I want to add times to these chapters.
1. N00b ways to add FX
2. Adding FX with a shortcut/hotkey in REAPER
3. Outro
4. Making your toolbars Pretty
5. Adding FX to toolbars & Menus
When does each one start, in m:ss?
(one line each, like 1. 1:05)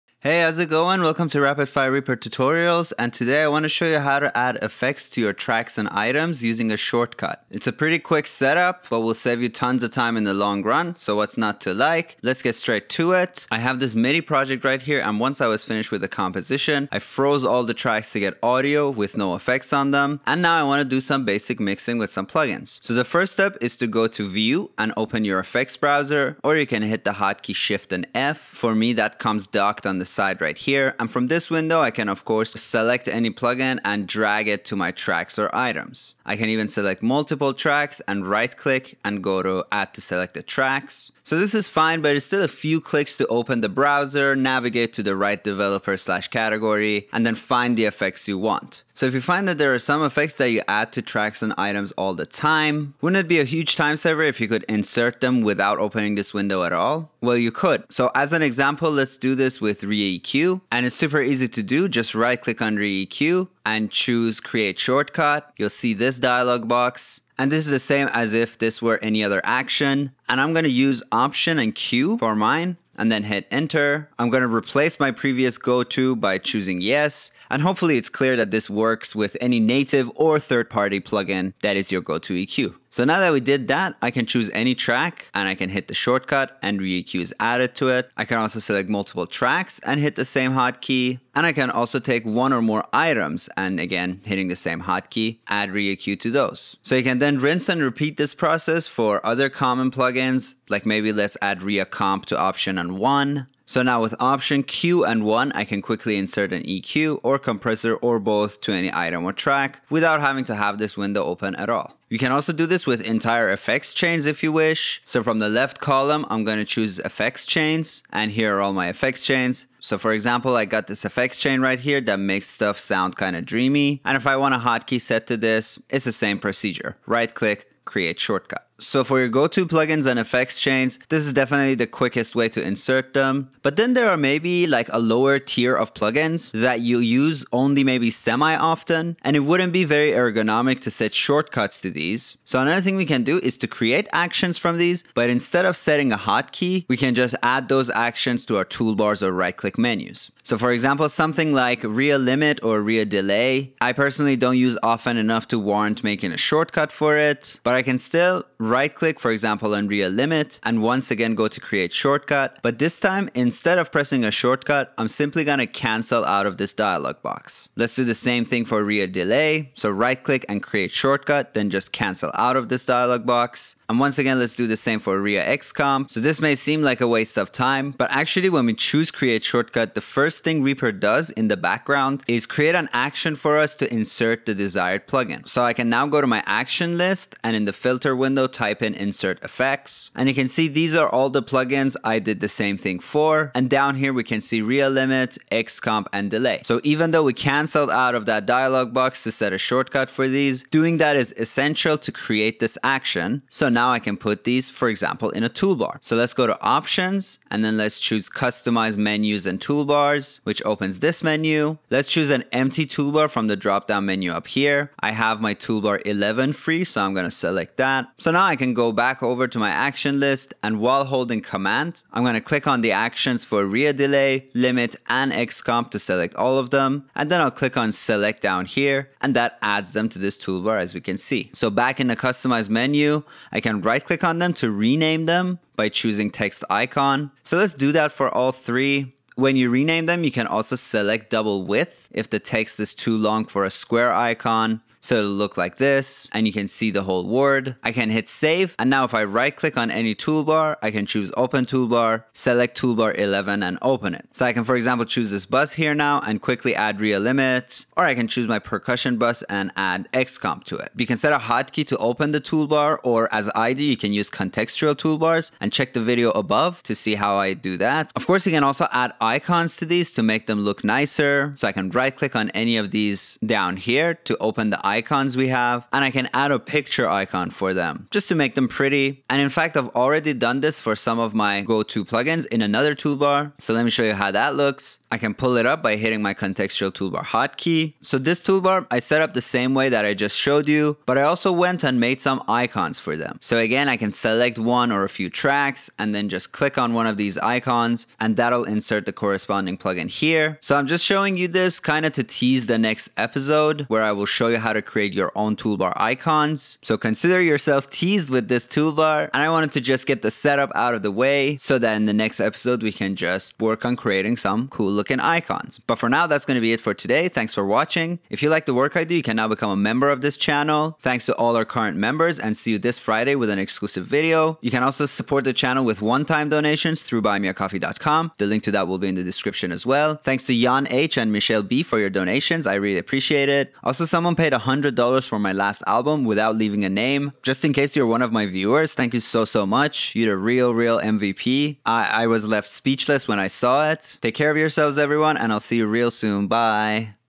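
1. 0:12
2. 0:49
3. 5:14
4. 4:39
5. 2:13.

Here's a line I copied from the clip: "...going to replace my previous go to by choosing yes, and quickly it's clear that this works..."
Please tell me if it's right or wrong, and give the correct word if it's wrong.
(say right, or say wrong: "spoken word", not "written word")
wrong: "hopefully", not "quickly".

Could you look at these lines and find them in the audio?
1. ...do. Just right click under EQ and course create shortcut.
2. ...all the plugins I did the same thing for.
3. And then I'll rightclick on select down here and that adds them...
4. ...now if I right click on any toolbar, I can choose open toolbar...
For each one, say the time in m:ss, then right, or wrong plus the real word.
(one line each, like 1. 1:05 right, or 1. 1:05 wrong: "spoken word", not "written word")
1. 1:01 wrong: "choose", not "course"
2. 3:11 right
3. 3:47 wrong: "click", not "rightclick"
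4. 4:08 right.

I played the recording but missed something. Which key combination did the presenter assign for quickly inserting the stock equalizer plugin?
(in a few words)
Option and Q.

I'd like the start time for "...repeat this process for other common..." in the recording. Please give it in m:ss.
1:37.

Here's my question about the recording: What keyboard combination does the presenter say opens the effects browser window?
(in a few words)
Shift and F.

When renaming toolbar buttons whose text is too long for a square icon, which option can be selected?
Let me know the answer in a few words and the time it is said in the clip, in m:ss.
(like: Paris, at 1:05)
Double width, at 4:01.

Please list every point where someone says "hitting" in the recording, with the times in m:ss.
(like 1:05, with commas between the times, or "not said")
1:34, 4:45.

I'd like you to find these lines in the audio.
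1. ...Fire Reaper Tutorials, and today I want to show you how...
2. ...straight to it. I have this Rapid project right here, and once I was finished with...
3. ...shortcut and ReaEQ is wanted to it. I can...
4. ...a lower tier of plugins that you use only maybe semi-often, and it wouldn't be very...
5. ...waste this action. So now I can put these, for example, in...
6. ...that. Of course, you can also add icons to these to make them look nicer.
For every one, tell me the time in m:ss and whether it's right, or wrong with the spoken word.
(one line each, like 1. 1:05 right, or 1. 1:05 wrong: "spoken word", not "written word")
1. 0:01 right
2. 0:12 wrong: "MIDI", not "Rapid"
3. 1:25 wrong: "added", not "wanted"
4. 2:14 right
5. 3:22 wrong: "create", not "waste"
6. 4:27 right.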